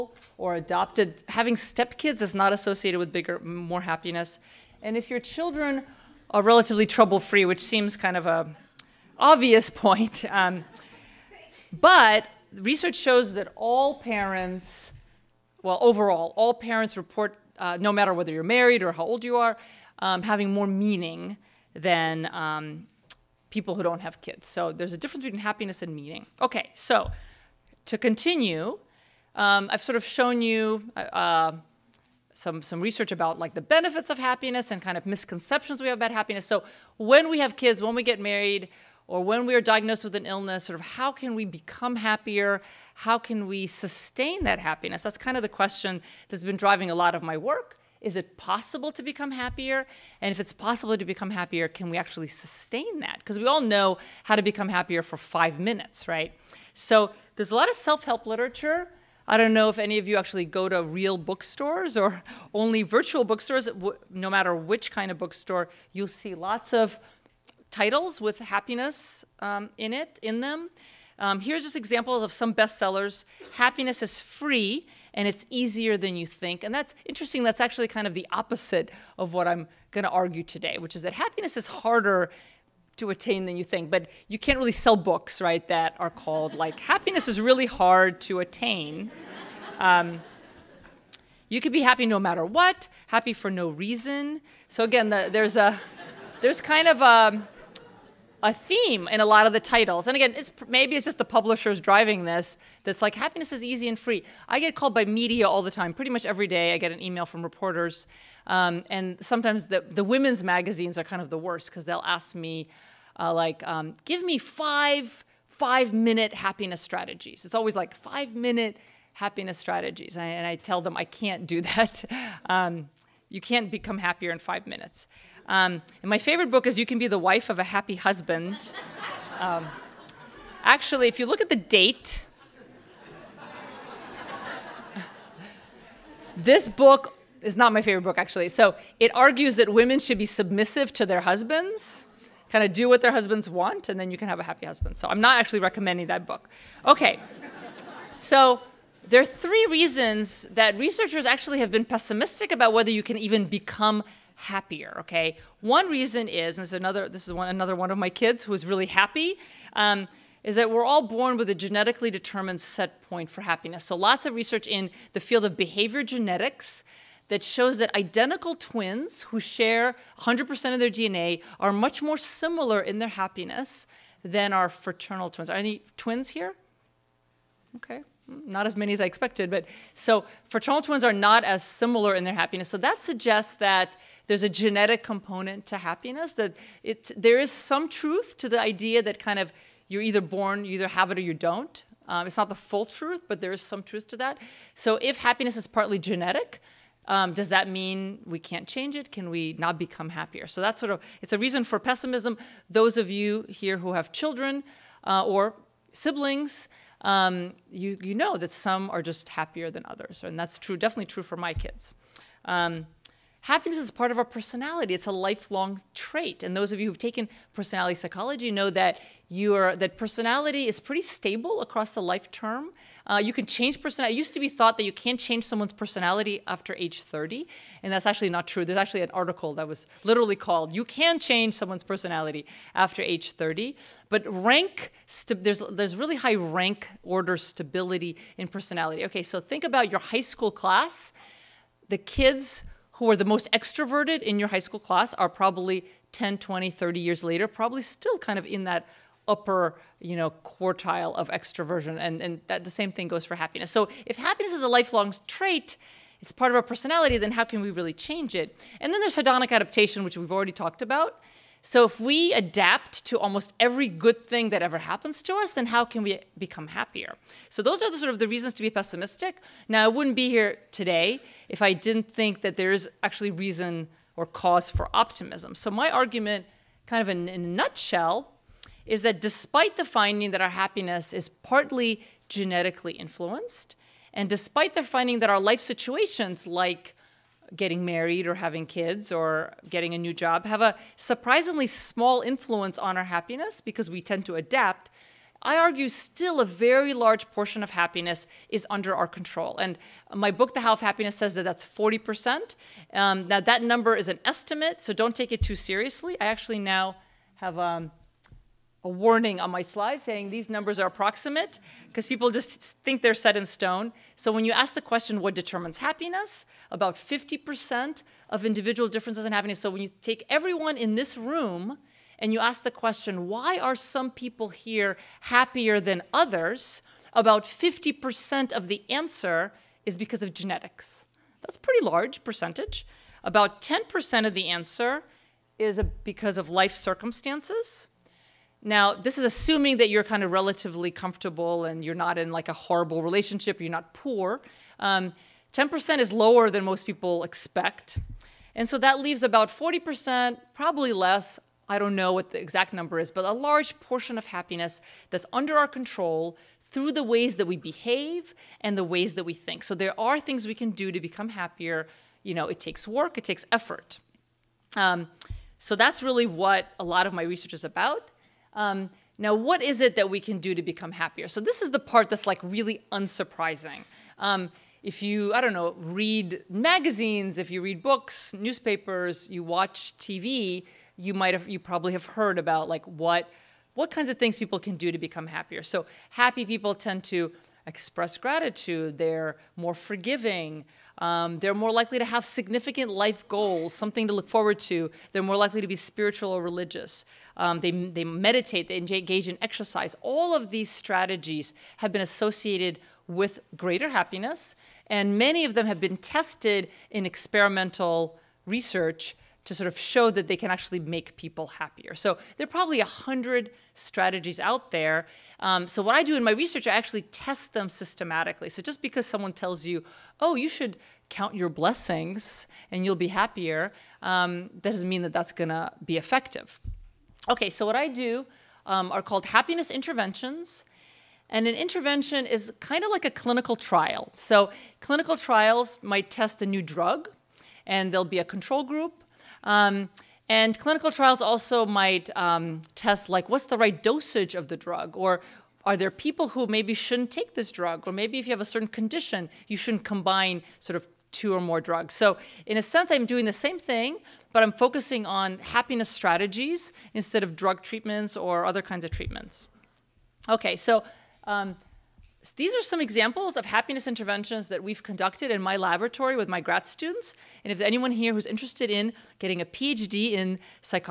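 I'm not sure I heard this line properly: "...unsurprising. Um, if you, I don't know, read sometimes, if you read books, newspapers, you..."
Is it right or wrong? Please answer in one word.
wrong.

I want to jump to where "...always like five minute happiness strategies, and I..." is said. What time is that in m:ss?
1:57.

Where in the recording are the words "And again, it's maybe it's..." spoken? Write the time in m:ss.
1:40.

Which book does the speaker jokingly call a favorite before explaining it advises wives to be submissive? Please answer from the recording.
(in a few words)
You Can Be the Wife of a Happy Husband.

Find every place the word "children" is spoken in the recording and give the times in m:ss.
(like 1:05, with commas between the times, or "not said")
0:05, 3:24.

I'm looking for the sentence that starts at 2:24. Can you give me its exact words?
So I'm not actually recommending that book.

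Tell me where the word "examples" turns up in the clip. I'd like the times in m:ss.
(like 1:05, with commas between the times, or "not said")
1:11, 7:42.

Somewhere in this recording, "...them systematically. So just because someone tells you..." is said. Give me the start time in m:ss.
6:57.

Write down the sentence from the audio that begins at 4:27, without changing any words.
So those are the sort of the reasons to be pessimistic.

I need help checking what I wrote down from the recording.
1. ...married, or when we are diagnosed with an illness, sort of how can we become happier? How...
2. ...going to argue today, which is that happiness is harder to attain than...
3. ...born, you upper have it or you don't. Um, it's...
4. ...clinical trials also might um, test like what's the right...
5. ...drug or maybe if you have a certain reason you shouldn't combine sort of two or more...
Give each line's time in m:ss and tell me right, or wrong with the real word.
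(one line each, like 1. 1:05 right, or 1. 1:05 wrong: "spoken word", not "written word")
1. 0:38 right
2. 1:19 right
3. 3:10 wrong: "either", not "upper"
4. 7:20 right
5. 7:27 wrong: "condition", not "reason".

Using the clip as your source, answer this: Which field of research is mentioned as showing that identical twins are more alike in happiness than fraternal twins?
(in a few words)
Behavior genetics.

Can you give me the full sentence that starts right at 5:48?
And so that leaves about 40%, probably less.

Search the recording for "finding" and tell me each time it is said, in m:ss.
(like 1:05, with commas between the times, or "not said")
4:39, 4:44.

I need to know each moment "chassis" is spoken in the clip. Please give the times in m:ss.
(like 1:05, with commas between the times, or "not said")
not said.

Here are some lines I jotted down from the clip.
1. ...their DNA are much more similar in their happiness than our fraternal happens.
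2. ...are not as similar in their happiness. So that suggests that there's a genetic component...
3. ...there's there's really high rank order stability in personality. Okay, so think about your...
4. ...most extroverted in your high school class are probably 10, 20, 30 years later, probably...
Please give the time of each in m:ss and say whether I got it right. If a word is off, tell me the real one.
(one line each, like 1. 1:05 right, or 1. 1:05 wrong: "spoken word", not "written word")
1. 2:50 wrong: "twins", not "happens"
2. 3:01 right
3. 3:55 right
4. 4:03 right.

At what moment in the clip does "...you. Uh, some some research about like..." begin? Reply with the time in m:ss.
0:30.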